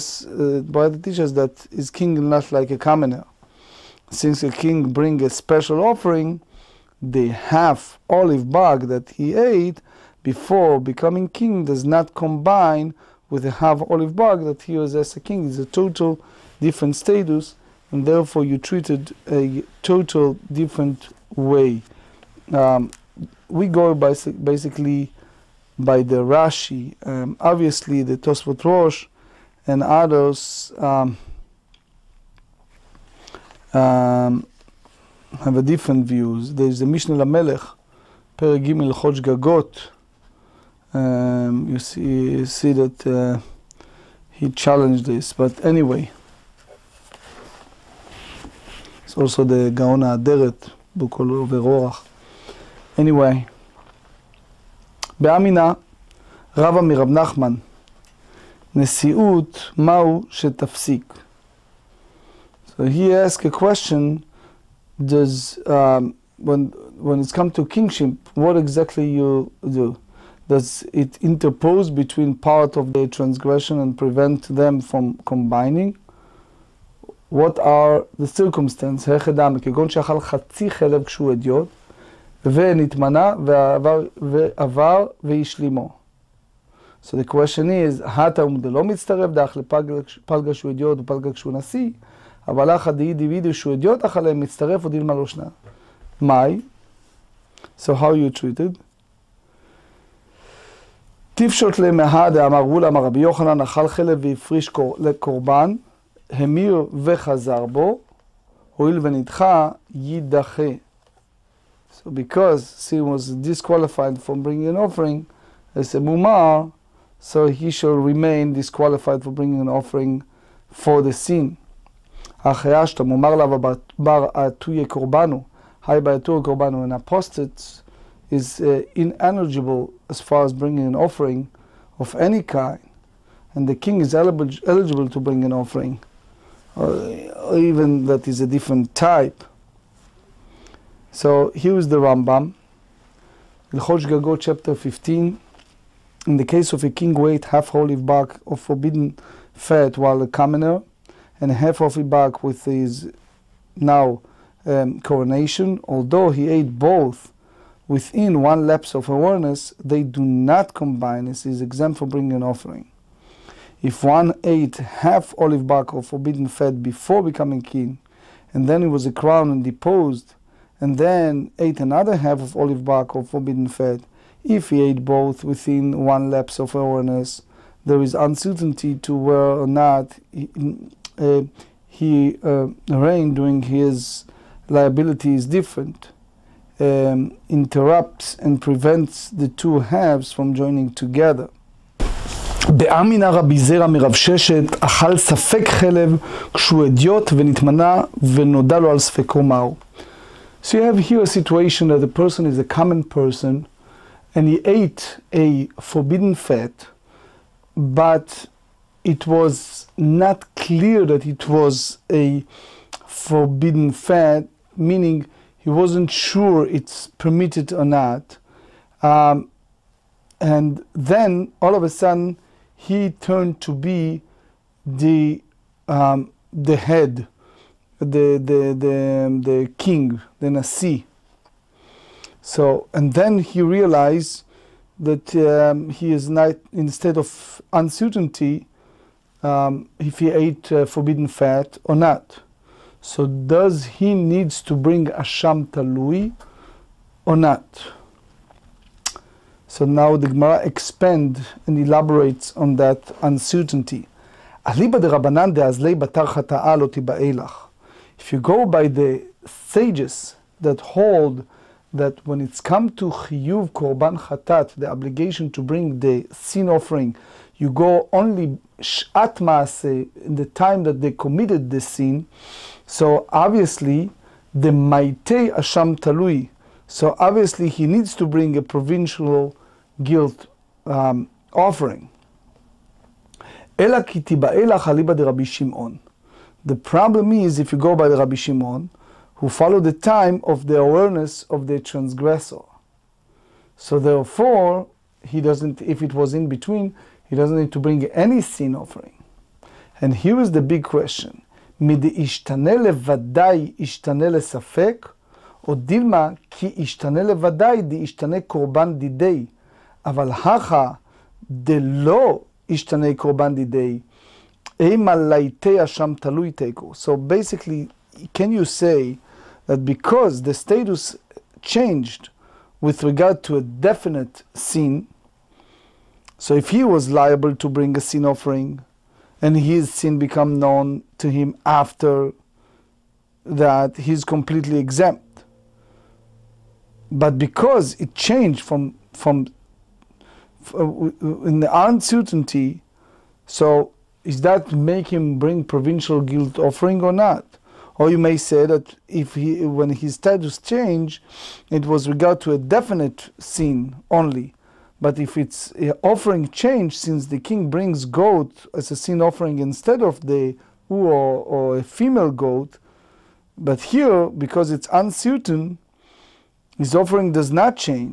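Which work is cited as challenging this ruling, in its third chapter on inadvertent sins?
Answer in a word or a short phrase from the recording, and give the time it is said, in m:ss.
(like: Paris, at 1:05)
Mishneh Lamelech, at 0:36.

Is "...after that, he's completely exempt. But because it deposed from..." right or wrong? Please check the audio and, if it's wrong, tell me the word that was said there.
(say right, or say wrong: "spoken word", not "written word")
wrong: "changed", not "deposed".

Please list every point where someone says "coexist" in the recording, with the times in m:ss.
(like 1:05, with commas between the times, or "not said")
not said.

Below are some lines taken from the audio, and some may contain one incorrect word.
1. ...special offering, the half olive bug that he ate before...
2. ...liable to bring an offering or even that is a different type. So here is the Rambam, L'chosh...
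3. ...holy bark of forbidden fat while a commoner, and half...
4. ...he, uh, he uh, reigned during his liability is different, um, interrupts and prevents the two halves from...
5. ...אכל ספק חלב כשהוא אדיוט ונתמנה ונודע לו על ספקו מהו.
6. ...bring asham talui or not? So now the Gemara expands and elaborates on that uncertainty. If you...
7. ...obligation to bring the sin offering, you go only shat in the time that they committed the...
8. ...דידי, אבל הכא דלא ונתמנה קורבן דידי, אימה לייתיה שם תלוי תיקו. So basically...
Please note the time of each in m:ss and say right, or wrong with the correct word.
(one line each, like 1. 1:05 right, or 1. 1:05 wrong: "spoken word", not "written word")
1. 0:05 right
2. 2:14 wrong: "eligible", not "liable"
3. 2:27 right
4. 3:00 right
5. 3:14 right
6. 4:04 right
7. 4:24 right
8. 5:08 wrong: "ישתנה", not "ונתמנה".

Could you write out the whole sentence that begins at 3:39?
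Um, and then all of a sudden, he turned to be the um, the head, the the the the king, the nasi.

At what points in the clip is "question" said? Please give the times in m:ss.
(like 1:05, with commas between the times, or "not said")
1:03, 1:27, 5:00.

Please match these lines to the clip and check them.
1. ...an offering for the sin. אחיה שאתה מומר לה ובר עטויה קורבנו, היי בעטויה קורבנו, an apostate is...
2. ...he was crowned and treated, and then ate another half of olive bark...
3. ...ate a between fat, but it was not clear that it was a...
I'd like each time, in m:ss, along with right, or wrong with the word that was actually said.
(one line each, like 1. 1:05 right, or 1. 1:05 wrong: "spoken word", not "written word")
1. 1:59 right
2. 2:48 wrong: "deposed", not "treated"
3. 3:24 wrong: "forbidden", not "between".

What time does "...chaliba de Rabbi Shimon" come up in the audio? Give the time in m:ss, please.
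4:44.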